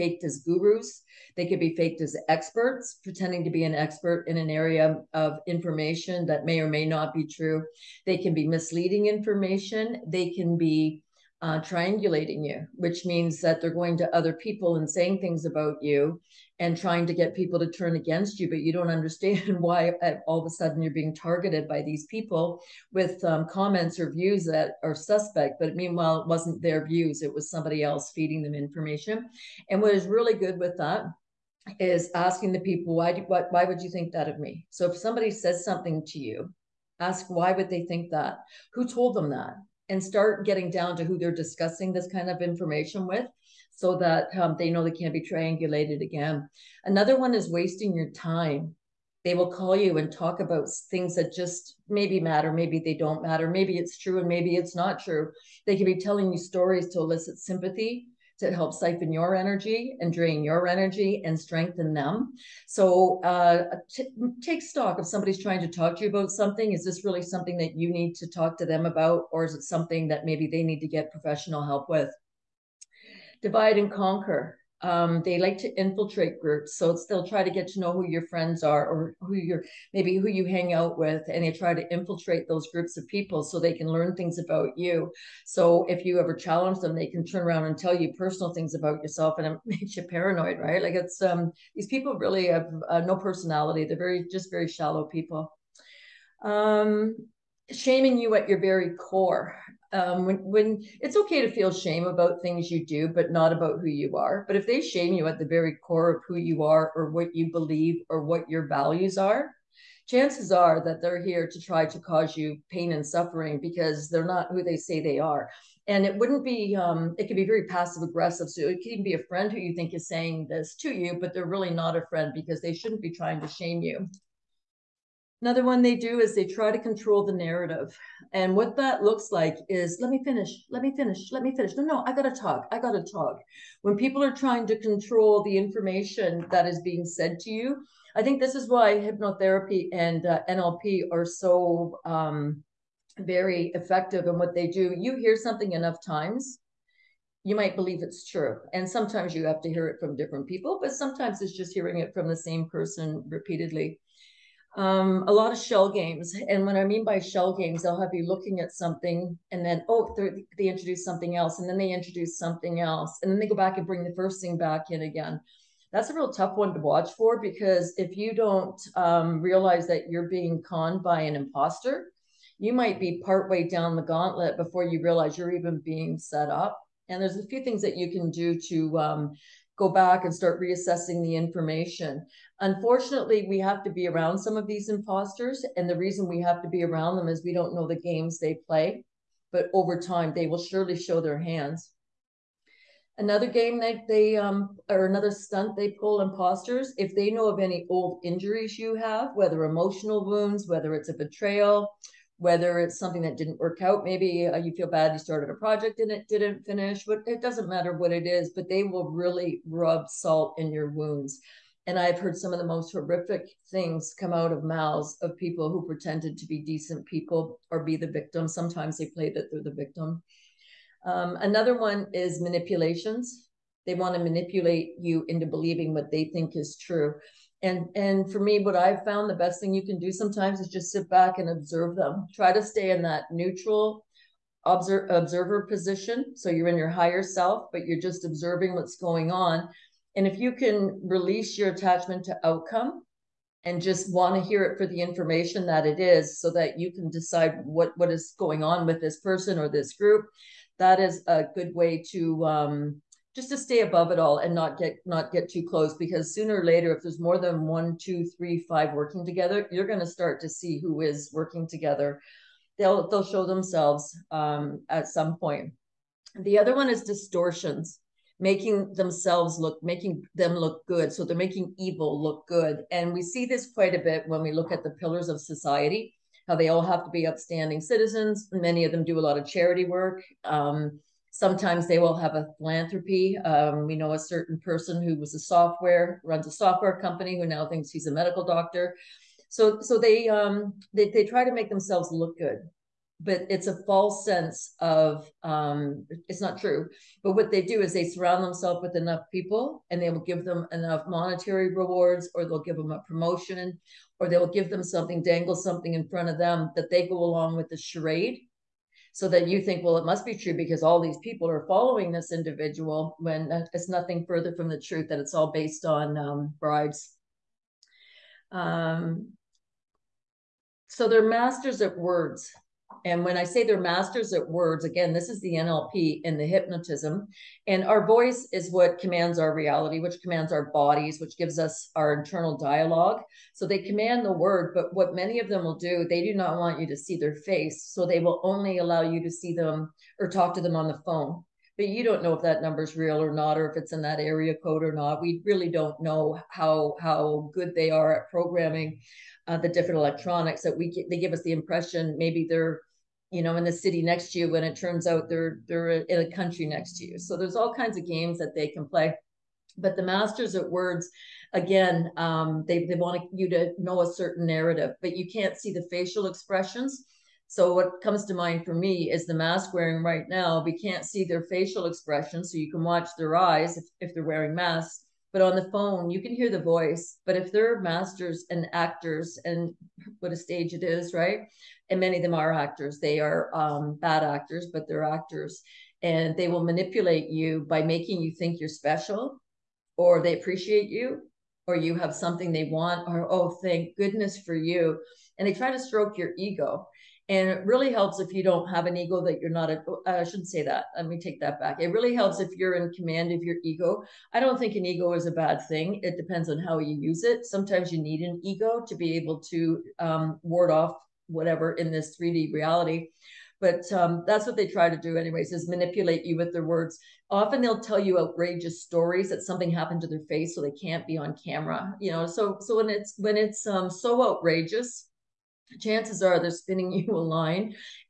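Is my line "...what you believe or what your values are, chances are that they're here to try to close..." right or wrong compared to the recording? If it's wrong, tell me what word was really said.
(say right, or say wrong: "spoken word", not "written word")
wrong: "cause", not "close".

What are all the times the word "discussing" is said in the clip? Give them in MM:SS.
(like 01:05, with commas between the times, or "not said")
00:41.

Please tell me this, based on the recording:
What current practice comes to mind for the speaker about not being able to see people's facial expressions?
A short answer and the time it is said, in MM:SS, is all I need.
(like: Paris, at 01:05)
Mask wearing, at 06:09.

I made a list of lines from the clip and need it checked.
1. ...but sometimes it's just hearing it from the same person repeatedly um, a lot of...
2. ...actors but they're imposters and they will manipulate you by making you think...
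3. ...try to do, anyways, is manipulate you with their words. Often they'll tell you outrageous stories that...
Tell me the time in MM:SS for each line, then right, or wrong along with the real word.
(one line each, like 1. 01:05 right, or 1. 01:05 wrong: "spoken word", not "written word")
1. 02:30 right
2. 06:24 wrong: "actors", not "imposters"
3. 06:54 right.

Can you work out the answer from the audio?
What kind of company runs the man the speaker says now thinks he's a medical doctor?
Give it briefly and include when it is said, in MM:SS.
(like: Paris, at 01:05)
Software company, at 04:46.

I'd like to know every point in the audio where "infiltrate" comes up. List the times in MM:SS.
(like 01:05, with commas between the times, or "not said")
01:15, 01:21.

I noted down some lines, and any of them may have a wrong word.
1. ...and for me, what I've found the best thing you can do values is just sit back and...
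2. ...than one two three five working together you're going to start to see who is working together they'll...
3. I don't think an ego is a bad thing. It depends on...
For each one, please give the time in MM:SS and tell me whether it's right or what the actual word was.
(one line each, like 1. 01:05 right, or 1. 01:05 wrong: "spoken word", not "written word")
1. 03:47 wrong: "sometimes", not "values"
2. 04:17 right
3. 06:44 right.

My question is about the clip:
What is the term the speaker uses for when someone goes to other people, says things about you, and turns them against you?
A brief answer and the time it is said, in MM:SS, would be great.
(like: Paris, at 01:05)
Triangulating, at 00:11.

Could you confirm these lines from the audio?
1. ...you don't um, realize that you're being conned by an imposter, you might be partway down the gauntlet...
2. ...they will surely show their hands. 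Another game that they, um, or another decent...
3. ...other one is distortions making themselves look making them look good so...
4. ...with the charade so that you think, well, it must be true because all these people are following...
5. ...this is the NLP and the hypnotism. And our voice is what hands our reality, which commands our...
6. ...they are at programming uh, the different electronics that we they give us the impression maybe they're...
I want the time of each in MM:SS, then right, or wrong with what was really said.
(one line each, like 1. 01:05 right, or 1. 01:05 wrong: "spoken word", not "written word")
1. 02:48 right
2. 03:10 wrong: "stunt", not "decent"
3. 04:26 right
4. 05:07 right
5. 05:25 wrong: "commands", not "hands"
6. 05:47 right.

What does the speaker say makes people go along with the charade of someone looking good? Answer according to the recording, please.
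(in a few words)
Bribes.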